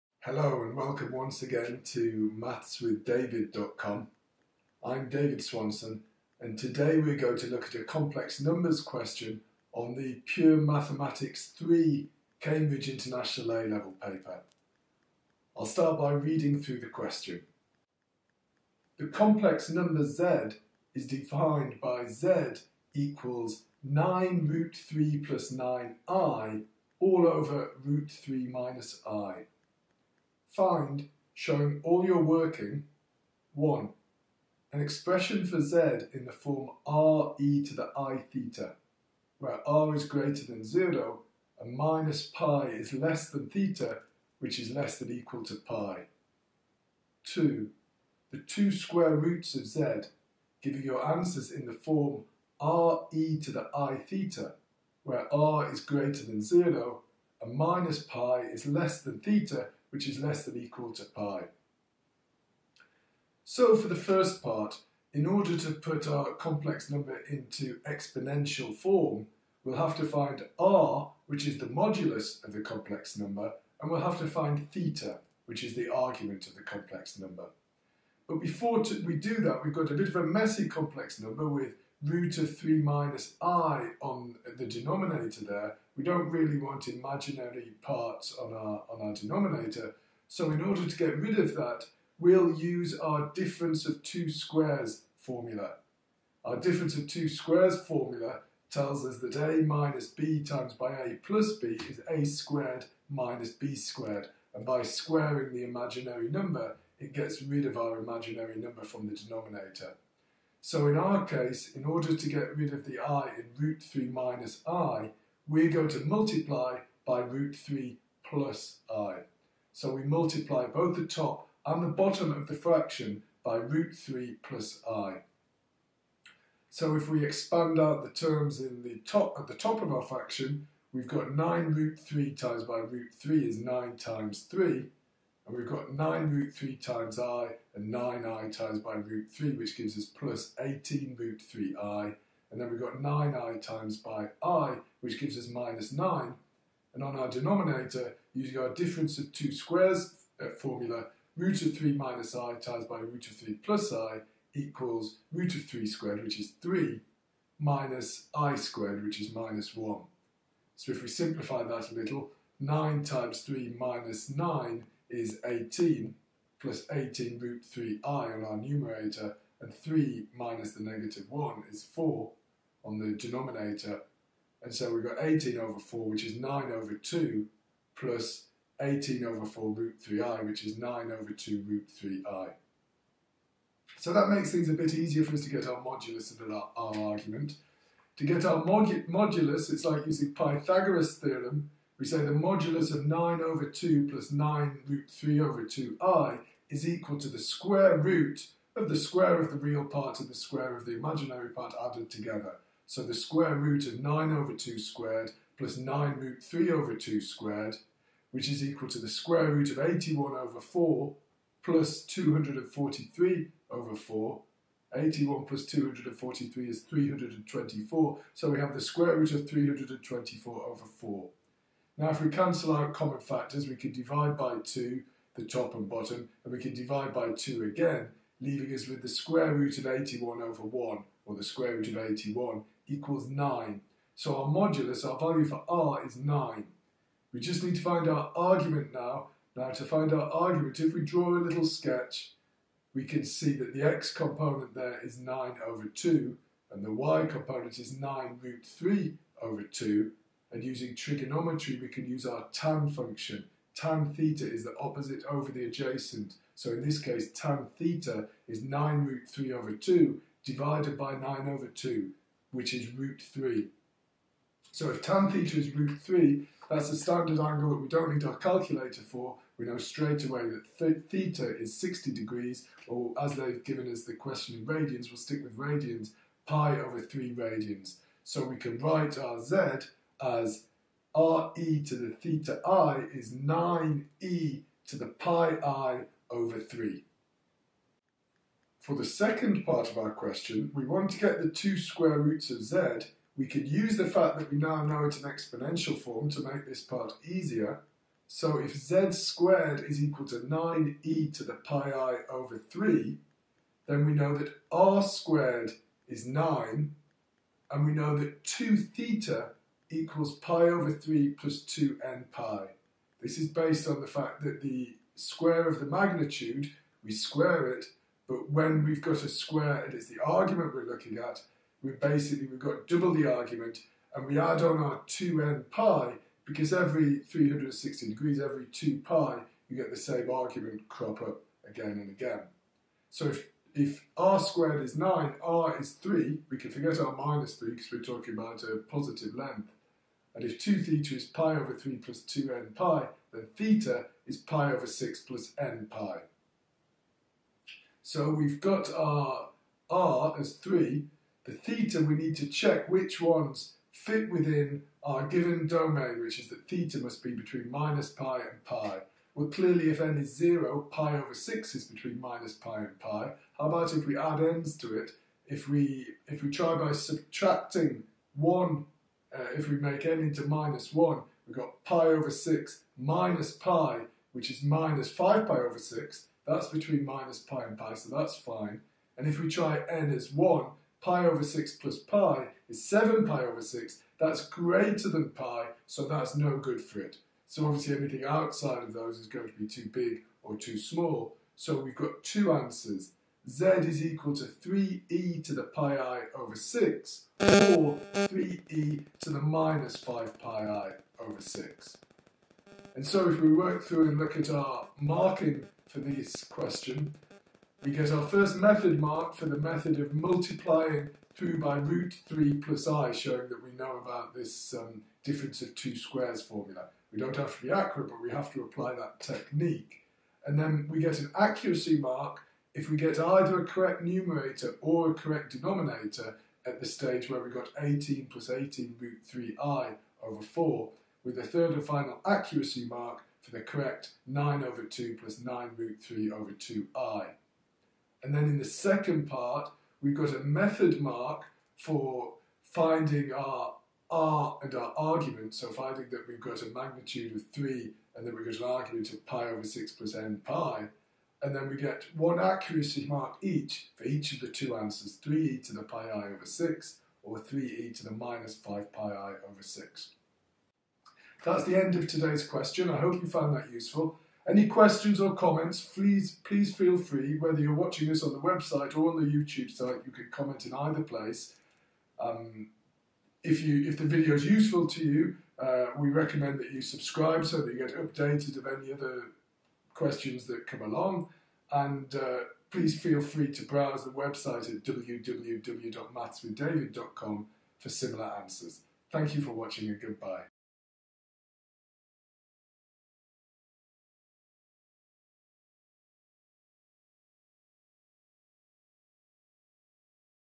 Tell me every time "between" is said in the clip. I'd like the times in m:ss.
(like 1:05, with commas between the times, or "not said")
5:57, 6:01, 6:16.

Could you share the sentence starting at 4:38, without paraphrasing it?
So we can write our z as re to the theta i is 9e to the pi i over 3.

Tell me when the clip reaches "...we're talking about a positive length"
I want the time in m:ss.
5:37.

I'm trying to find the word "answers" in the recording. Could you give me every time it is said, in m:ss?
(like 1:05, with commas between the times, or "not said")
0:51, 6:32, 7:34, 8:08.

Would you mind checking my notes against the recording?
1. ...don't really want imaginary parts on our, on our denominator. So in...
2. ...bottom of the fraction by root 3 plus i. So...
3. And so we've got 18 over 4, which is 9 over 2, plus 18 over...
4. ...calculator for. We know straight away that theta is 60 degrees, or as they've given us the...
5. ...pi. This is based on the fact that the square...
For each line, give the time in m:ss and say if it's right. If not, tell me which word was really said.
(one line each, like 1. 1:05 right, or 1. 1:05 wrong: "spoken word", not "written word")
1. 1:26 right
2. 2:01 right
3. 2:54 right
4. 4:28 right
5. 5:12 right.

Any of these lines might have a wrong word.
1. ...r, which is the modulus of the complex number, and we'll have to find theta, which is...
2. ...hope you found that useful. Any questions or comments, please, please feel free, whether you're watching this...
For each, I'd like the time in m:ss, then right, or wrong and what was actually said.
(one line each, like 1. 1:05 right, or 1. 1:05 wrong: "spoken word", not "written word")
1. 1:10 right
2. 7:42 right.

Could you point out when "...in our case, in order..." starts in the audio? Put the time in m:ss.
1:50.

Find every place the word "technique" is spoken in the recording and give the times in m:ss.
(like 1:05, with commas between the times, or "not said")
6:59.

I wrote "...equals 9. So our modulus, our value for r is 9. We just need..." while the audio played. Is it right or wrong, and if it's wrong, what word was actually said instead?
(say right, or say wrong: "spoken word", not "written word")
right.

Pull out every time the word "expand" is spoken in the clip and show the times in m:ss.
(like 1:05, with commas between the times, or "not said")
2:07.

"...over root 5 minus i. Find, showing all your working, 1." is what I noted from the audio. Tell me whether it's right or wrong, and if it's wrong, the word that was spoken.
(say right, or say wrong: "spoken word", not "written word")
wrong: "3", not "5".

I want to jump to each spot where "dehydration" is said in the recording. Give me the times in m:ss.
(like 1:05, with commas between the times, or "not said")
not said.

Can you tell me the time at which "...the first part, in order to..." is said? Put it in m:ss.
1:03.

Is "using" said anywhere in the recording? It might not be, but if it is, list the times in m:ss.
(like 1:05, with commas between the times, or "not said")
2:28, 3:10, 4:10.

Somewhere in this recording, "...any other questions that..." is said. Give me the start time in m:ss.
7:58.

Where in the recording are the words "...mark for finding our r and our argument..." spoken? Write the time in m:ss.
7:21.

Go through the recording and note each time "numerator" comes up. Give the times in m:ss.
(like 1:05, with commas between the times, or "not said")
2:48, 7:04.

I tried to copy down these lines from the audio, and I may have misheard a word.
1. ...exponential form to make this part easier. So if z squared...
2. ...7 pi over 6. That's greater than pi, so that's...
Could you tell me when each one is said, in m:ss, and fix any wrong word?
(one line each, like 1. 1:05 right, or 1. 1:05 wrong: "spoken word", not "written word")
1. 4:55 right
2. 6:22 right.